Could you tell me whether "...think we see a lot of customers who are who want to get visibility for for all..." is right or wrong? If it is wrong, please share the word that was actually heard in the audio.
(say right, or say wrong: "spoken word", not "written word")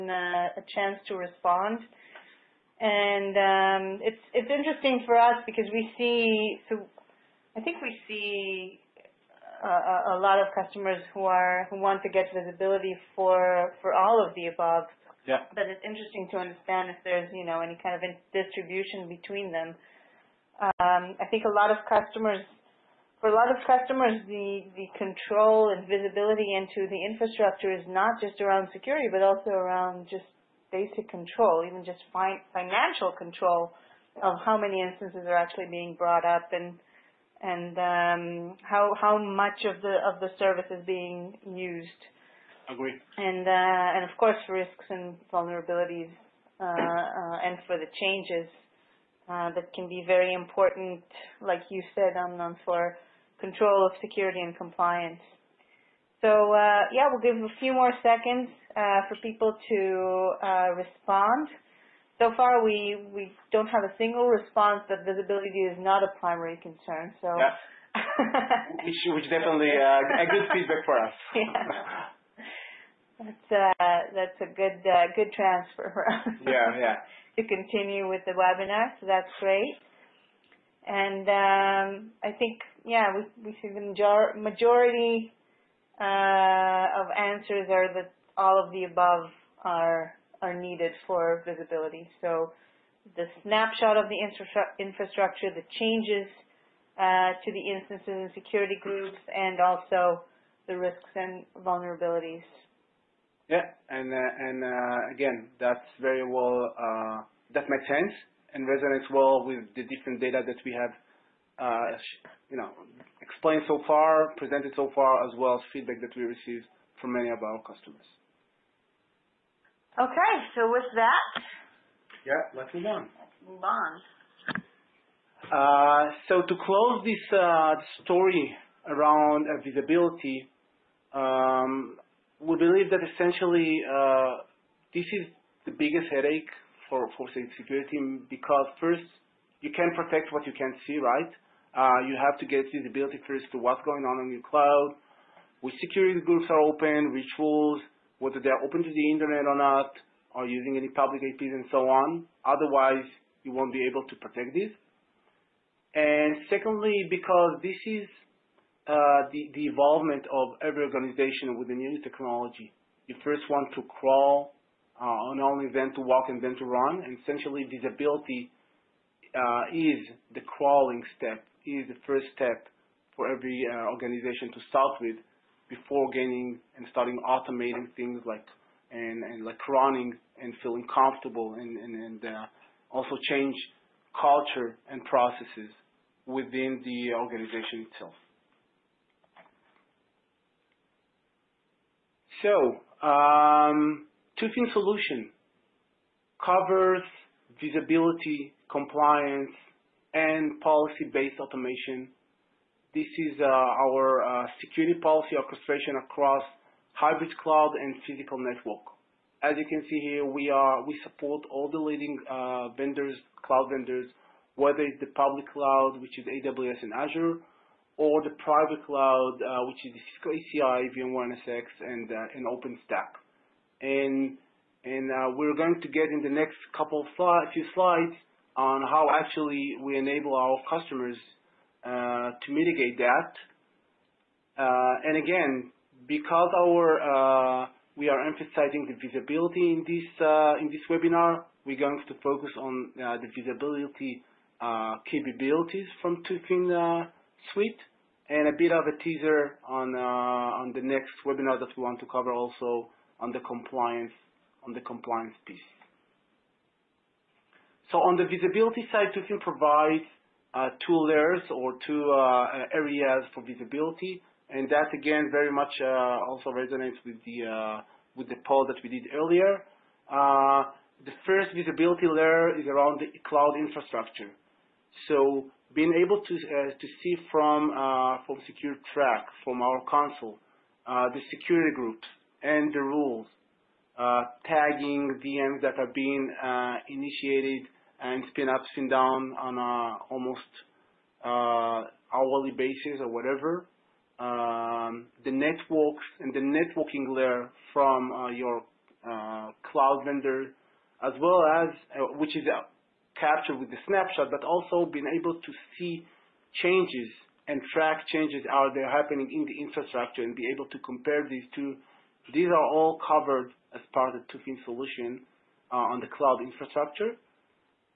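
right.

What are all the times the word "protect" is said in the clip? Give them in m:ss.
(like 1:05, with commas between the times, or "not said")
2:19, 2:34.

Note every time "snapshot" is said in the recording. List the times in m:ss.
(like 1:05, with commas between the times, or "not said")
1:33, 5:03.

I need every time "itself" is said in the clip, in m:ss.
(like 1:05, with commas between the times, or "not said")
3:07.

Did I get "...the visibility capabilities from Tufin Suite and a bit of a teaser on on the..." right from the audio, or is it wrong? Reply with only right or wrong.
right.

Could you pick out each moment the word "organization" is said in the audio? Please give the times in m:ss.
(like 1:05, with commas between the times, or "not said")
2:40, 2:53, 3:07.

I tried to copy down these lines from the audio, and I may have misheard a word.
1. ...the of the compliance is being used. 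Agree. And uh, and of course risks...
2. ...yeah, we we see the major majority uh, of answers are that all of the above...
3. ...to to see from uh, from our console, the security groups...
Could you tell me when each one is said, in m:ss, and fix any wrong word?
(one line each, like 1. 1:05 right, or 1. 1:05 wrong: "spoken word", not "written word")
1. 0:39 wrong: "service", not "compliance"
2. 1:22 right
3. 4:36 right.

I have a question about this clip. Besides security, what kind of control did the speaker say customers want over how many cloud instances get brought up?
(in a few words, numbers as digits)
financial control.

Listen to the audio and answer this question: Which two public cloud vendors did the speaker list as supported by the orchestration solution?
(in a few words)
AWS and Azure.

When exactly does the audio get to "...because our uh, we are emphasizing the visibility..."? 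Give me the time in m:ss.
3:56.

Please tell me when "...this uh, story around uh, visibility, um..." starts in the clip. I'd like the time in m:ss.
2:07.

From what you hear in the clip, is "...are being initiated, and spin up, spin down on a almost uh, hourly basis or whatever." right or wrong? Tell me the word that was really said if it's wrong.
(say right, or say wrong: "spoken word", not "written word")
right.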